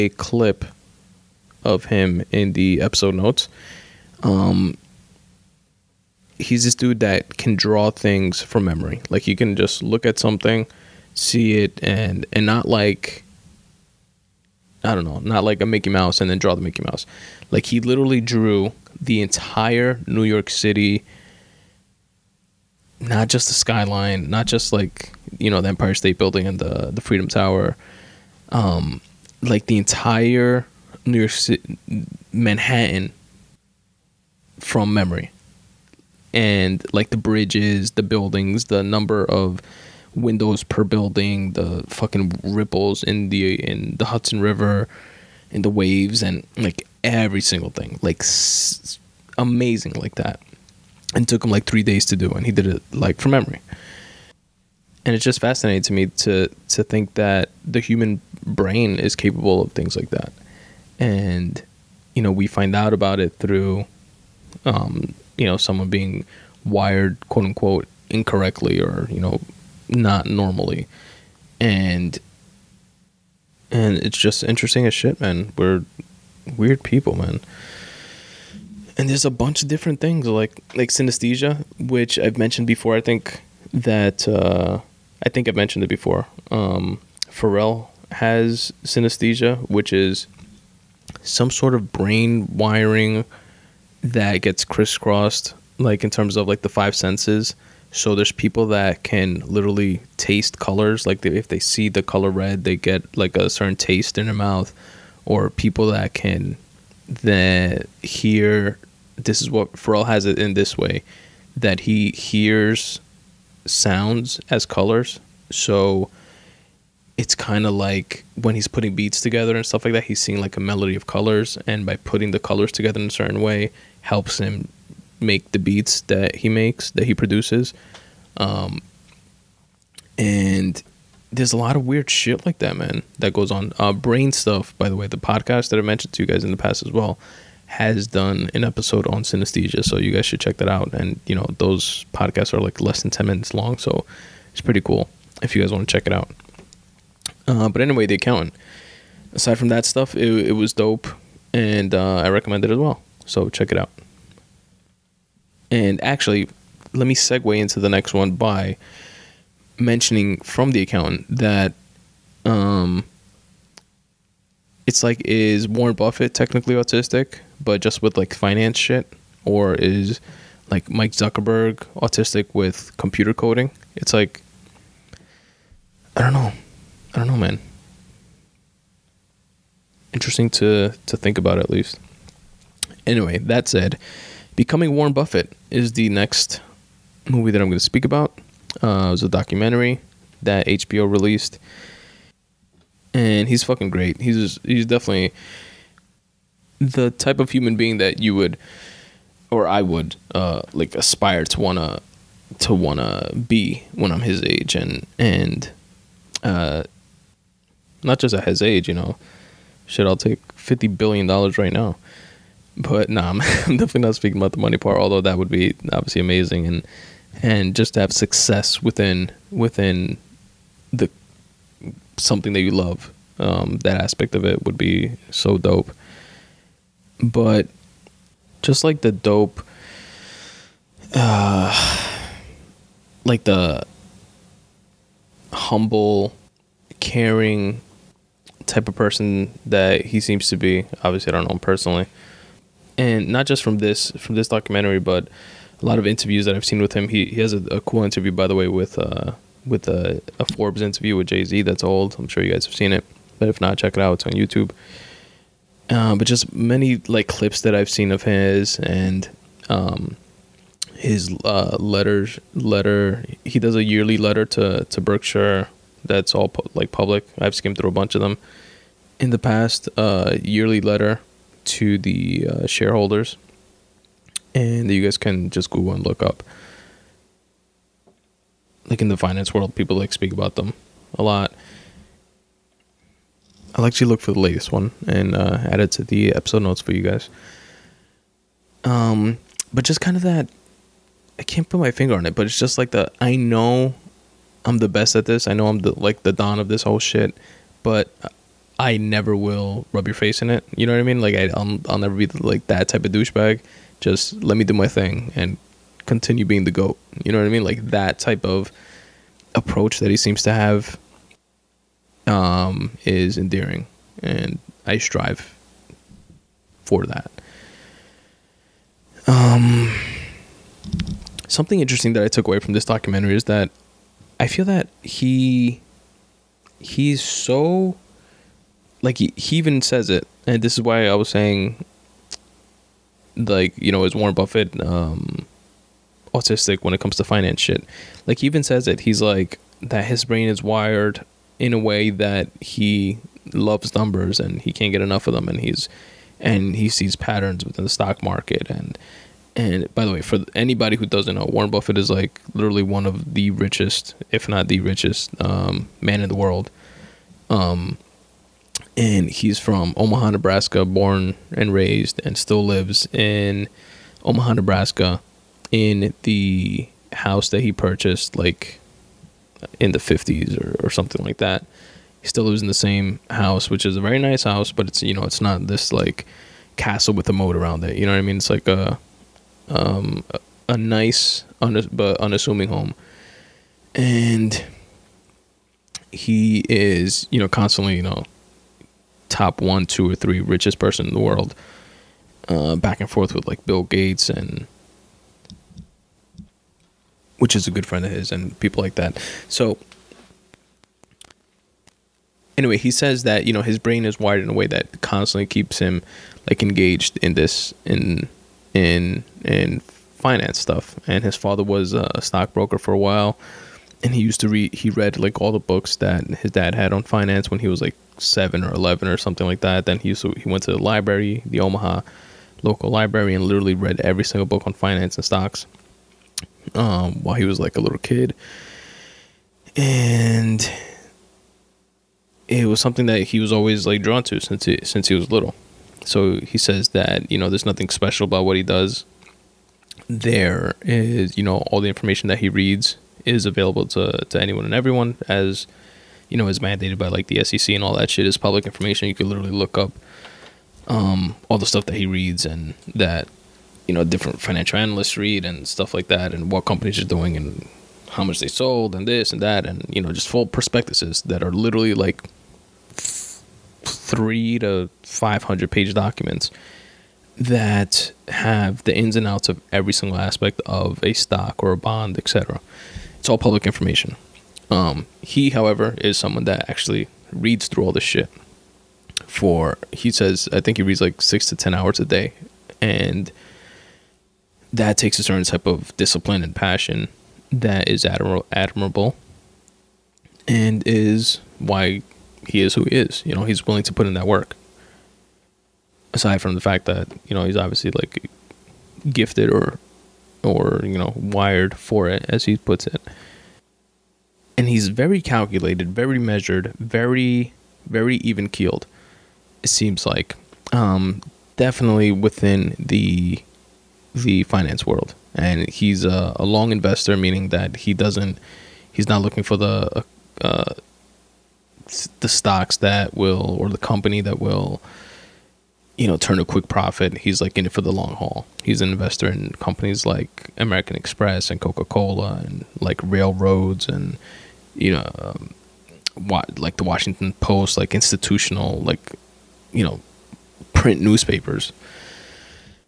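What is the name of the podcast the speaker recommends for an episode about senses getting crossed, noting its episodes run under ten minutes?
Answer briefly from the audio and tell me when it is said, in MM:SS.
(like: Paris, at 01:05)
Brain Stuff, at 02:13.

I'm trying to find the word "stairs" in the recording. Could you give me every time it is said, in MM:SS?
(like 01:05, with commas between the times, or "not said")
not said.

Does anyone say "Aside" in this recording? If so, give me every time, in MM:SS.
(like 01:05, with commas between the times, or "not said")
02:29, 08:16.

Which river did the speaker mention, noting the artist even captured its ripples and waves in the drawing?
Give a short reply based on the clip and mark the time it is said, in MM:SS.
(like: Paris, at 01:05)
Hudson River, at 00:44.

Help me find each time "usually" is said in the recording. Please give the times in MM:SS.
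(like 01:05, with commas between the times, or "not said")
not said.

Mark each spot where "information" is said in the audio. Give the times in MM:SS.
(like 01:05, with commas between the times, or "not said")
07:21, 07:28, 07:53.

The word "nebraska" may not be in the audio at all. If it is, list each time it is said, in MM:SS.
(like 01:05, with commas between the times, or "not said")
06:00, 06:04.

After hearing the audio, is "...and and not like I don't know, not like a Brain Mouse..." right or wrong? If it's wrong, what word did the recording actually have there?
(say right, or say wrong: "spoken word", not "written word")
wrong: "Mickey", not "Brain".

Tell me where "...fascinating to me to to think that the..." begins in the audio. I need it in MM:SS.
00:55.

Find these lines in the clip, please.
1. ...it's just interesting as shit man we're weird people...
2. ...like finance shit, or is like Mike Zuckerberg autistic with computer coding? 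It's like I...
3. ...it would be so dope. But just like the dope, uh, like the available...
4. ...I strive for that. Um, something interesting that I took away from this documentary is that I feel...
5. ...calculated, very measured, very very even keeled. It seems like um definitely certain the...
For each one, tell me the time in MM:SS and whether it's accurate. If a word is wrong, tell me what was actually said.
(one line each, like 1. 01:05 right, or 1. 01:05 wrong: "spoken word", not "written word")
1. 01:13 right
2. 02:48 right
3. 03:44 wrong: "humble", not "available"
4. 05:14 right
5. 08:25 wrong: "within", not "certain".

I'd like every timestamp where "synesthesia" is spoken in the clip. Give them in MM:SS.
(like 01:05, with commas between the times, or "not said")
01:20, 01:28, 02:19.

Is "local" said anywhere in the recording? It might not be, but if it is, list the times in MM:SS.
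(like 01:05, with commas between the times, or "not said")
07:02.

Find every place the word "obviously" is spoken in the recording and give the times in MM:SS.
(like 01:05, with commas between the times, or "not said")
03:35, 04:01, 08:17.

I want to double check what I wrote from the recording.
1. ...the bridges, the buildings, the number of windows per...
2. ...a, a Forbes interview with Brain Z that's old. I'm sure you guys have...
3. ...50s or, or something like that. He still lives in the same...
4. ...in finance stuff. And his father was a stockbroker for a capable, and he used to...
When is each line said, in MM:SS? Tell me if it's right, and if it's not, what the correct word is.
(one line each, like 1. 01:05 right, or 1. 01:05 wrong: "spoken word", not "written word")
1. 00:37 right
2. 04:09 wrong: "Jay", not "Brain"
3. 06:09 right
4. 06:49 wrong: "while", not "capable".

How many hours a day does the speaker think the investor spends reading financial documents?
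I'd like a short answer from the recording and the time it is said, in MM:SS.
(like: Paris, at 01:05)
6 to 10, at 08:01.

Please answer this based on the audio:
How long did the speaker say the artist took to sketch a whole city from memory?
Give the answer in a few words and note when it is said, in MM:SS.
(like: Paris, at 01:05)
3 days, at 00:51.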